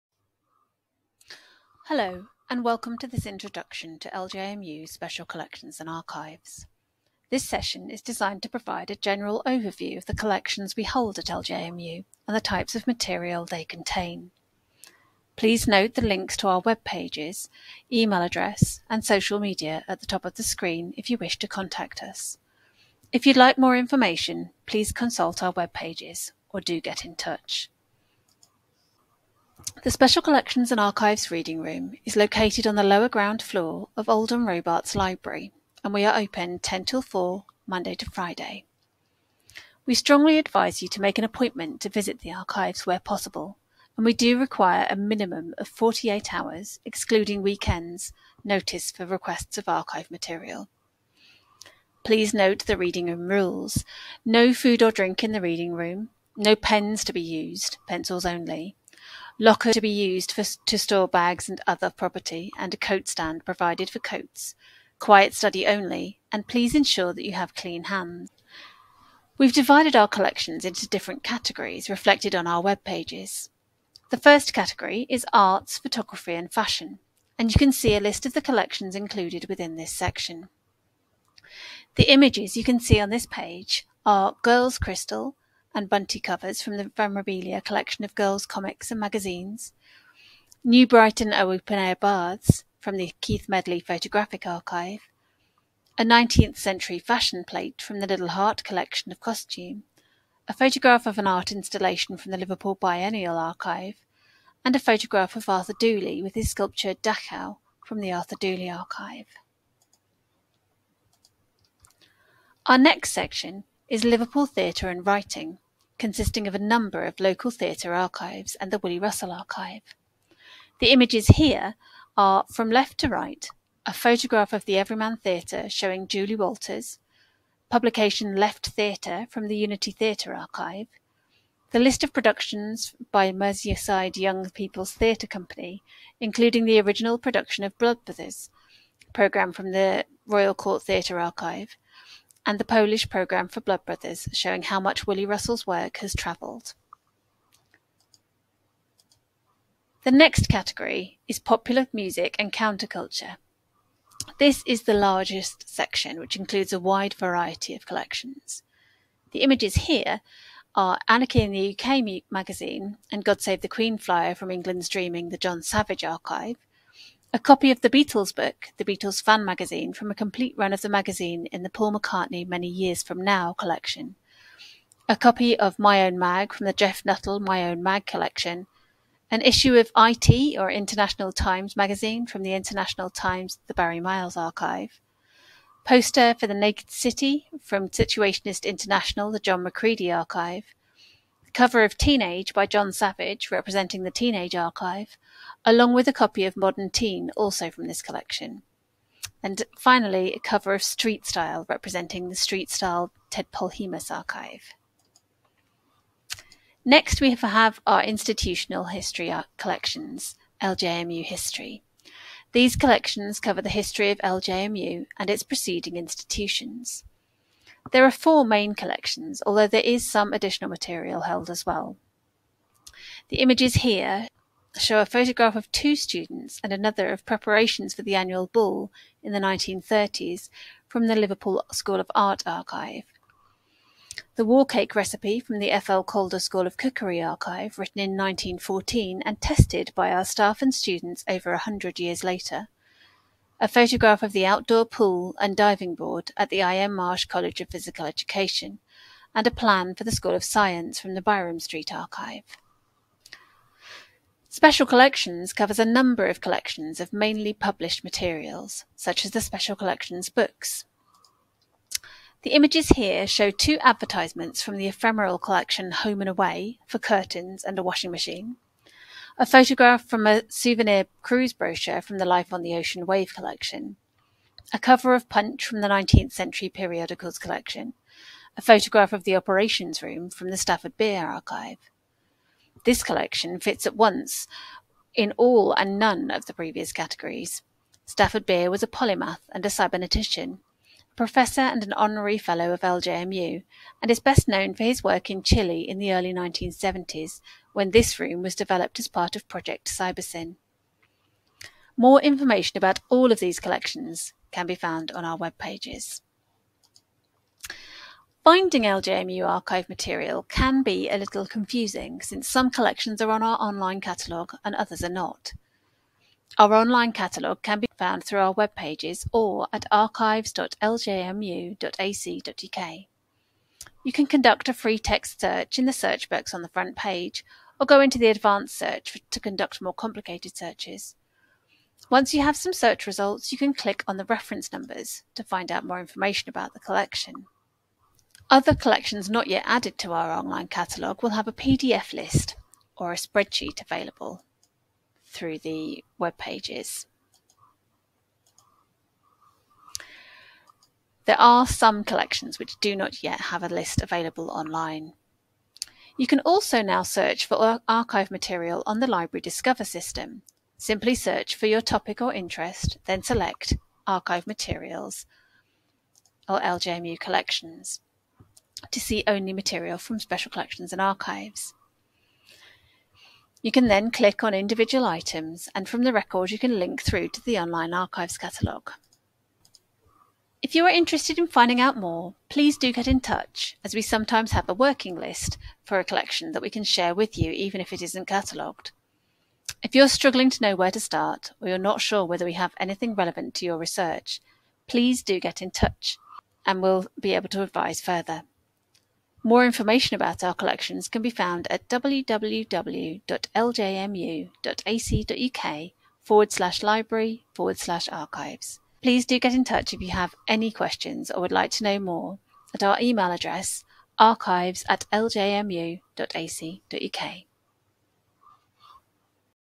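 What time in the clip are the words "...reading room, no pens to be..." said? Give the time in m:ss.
0:55.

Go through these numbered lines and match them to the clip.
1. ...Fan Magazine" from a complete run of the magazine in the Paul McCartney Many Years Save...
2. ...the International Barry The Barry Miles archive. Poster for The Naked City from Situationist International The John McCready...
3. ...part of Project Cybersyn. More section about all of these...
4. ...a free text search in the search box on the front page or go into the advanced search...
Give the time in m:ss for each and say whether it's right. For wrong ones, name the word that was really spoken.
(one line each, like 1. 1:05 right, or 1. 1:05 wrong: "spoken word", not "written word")
1. 2:49 wrong: "From", not "Save"
2. 3:02 wrong: "Times", not "Barry"
3. 4:59 wrong: "information", not "section"
4. 5:24 right.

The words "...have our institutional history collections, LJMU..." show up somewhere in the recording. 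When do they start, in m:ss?
3:27.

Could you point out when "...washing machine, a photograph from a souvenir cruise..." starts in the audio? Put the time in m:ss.
4:27.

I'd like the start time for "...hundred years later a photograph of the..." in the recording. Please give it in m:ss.
4:01.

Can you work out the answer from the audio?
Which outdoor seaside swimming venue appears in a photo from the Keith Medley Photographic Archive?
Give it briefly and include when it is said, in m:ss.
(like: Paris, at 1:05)
New Brighton open-air baths, at 1:30.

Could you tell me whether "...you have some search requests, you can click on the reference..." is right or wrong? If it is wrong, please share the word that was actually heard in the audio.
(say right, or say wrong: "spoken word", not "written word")
wrong: "results", not "requests".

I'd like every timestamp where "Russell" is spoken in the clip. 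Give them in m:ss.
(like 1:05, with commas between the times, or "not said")
1:58, 2:25.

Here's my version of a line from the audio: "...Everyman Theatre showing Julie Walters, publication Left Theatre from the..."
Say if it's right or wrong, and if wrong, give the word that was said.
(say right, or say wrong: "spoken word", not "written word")
right.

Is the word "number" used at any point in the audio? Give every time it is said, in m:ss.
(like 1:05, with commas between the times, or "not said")
1:56, 4:15, 5:34.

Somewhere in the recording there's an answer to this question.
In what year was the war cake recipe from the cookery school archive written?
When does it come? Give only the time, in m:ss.
3:58.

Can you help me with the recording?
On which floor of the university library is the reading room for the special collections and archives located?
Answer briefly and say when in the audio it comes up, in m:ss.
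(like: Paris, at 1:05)
Lower ground floor, at 0:32.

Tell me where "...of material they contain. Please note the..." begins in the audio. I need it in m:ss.
0:12.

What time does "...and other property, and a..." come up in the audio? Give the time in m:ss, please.
1:01.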